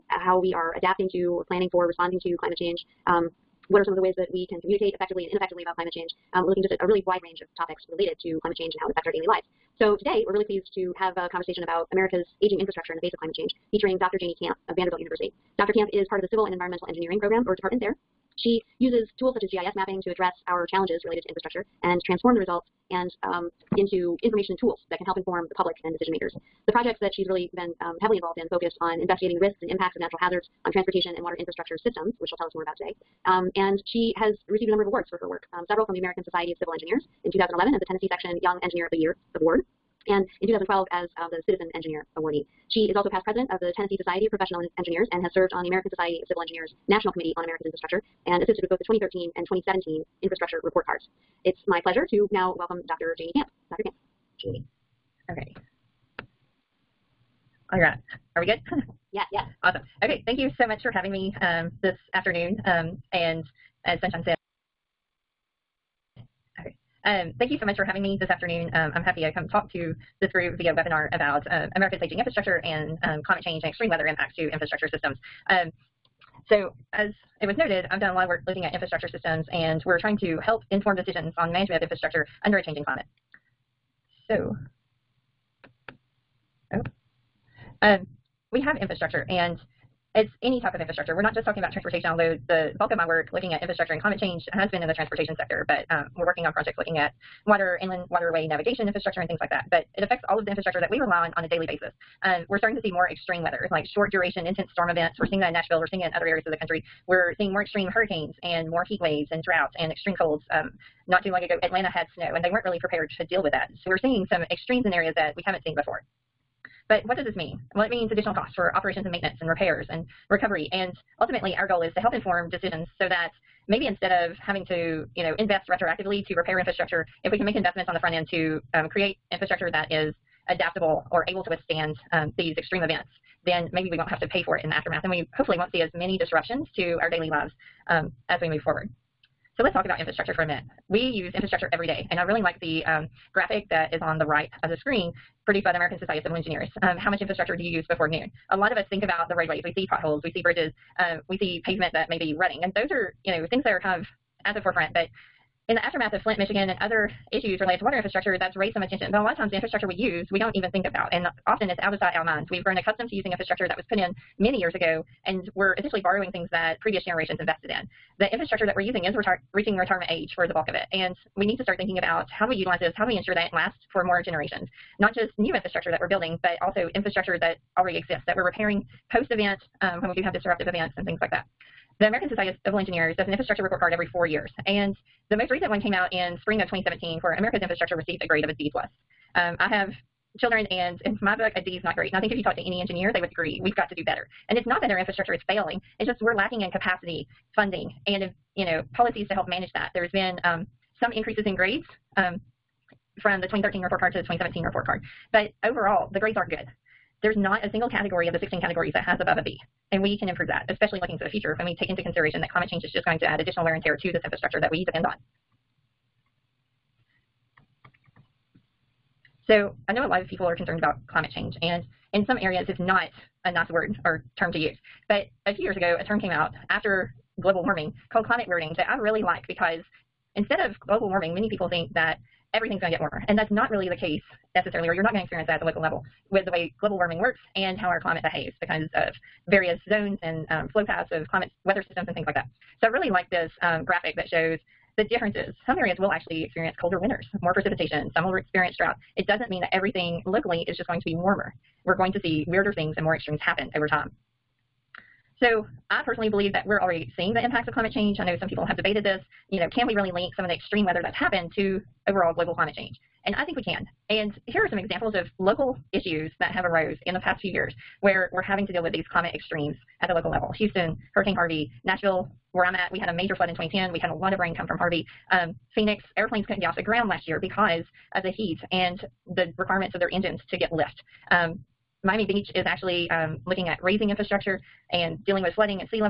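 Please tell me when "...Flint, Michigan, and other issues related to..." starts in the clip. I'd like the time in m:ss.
2:36.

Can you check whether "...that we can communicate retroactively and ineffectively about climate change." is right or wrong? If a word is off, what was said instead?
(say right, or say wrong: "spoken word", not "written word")
wrong: "effectively", not "retroactively".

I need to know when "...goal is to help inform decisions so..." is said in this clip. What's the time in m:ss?
2:01.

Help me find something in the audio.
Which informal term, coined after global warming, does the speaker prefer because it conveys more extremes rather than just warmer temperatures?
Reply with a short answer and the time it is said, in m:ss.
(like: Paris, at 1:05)
climate weirding, at 3:48.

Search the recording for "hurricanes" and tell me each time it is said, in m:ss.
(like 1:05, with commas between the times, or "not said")
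1:47, 4:31.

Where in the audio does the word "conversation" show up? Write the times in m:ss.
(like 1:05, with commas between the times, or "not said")
0:11.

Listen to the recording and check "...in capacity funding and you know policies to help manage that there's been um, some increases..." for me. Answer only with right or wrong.
right.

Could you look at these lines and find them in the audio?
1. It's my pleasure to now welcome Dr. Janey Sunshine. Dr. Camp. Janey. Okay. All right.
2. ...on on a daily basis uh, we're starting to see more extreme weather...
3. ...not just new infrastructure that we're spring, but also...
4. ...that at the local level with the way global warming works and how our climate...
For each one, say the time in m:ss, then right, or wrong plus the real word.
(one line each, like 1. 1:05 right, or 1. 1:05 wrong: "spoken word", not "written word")
1. 0:51 wrong: "Camp", not "Sunshine"
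2. 1:41 right
3. 2:54 wrong: "building", not "spring"
4. 3:55 right.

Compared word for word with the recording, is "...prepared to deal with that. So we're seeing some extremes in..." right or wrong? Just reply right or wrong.
right.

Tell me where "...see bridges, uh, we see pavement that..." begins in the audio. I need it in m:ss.
2:30.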